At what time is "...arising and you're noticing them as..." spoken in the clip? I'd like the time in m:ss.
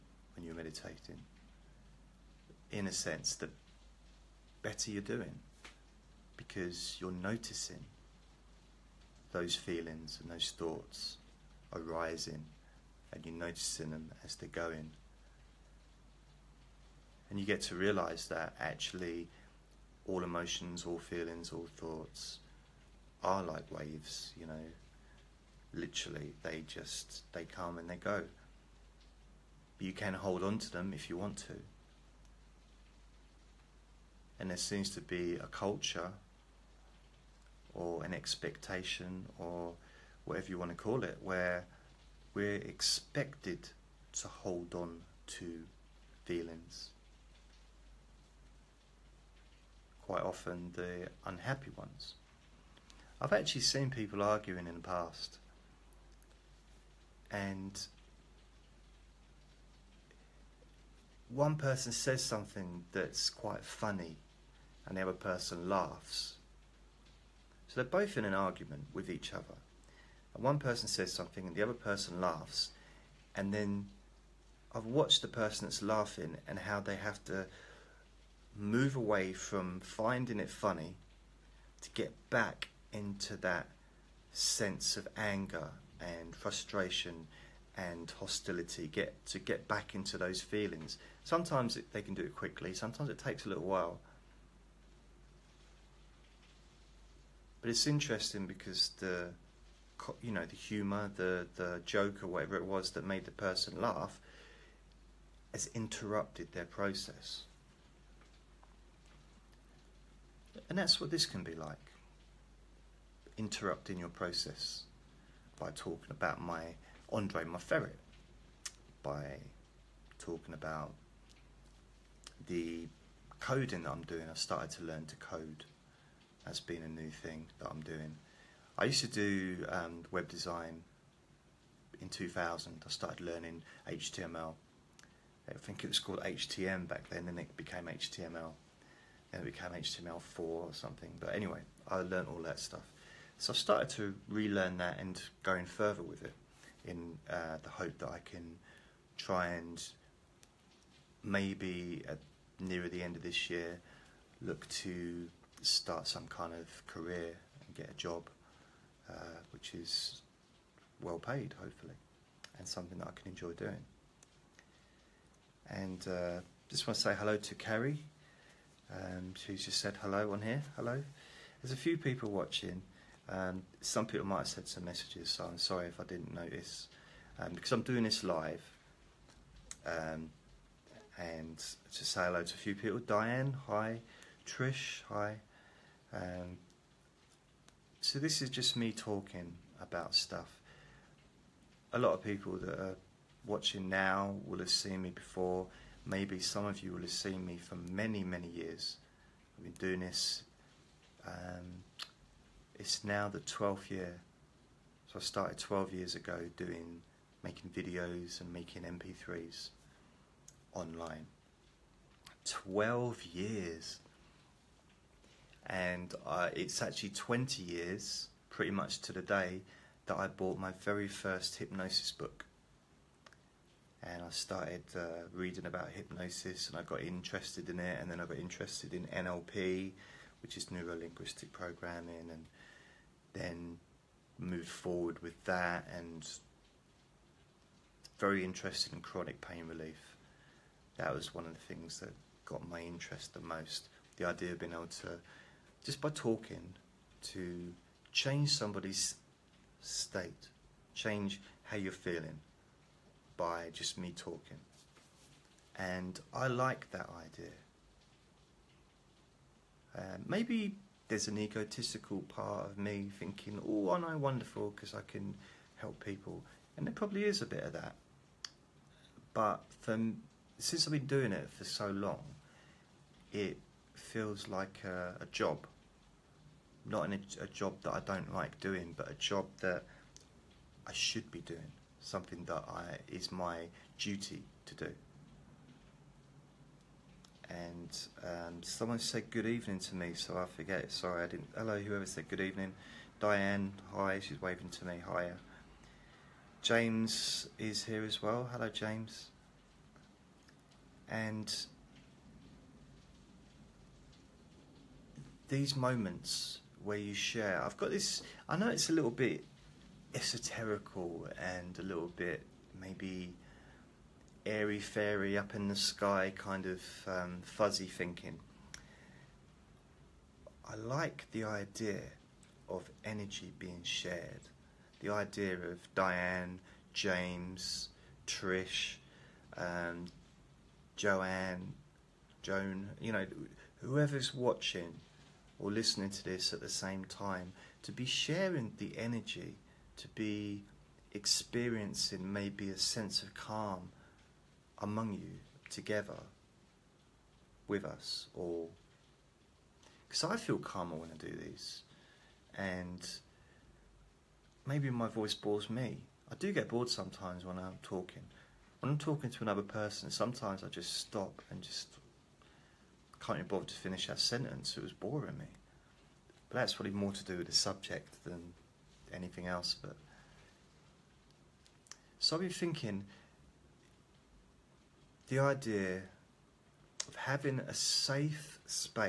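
0:11.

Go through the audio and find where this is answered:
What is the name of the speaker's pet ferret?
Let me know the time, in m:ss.
1:57.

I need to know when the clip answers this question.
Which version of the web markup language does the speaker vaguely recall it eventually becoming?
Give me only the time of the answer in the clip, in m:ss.
2:19.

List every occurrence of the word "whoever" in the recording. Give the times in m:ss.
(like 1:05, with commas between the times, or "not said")
4:51, 5:33.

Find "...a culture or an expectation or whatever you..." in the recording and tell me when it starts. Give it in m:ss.
0:35.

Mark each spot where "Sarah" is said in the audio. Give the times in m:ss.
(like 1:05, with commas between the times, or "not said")
not said.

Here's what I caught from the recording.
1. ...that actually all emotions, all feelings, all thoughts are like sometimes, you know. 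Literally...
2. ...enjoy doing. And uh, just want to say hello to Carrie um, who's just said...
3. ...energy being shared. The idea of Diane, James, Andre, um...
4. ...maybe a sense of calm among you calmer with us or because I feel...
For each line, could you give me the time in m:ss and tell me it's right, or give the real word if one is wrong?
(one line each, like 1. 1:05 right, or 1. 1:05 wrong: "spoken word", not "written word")
1. 0:18 wrong: "waves", not "sometimes"
2. 2:43 right
3. 5:23 wrong: "Trish", not "Andre"
4. 5:42 wrong: "together", not "calmer".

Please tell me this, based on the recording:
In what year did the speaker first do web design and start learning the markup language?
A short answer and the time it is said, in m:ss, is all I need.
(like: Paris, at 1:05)
2000, at 2:12.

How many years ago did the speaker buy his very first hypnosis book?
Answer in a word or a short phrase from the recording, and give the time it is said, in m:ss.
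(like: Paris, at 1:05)
20, at 3:37.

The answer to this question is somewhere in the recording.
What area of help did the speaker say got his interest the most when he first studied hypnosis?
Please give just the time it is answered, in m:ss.
3:58.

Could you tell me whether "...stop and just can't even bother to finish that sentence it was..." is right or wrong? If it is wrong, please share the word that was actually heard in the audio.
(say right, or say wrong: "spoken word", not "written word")
right.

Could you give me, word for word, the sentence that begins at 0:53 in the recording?
I've actually seen people arguing in the past, and one person says something that's quite funny, and the other person laughs.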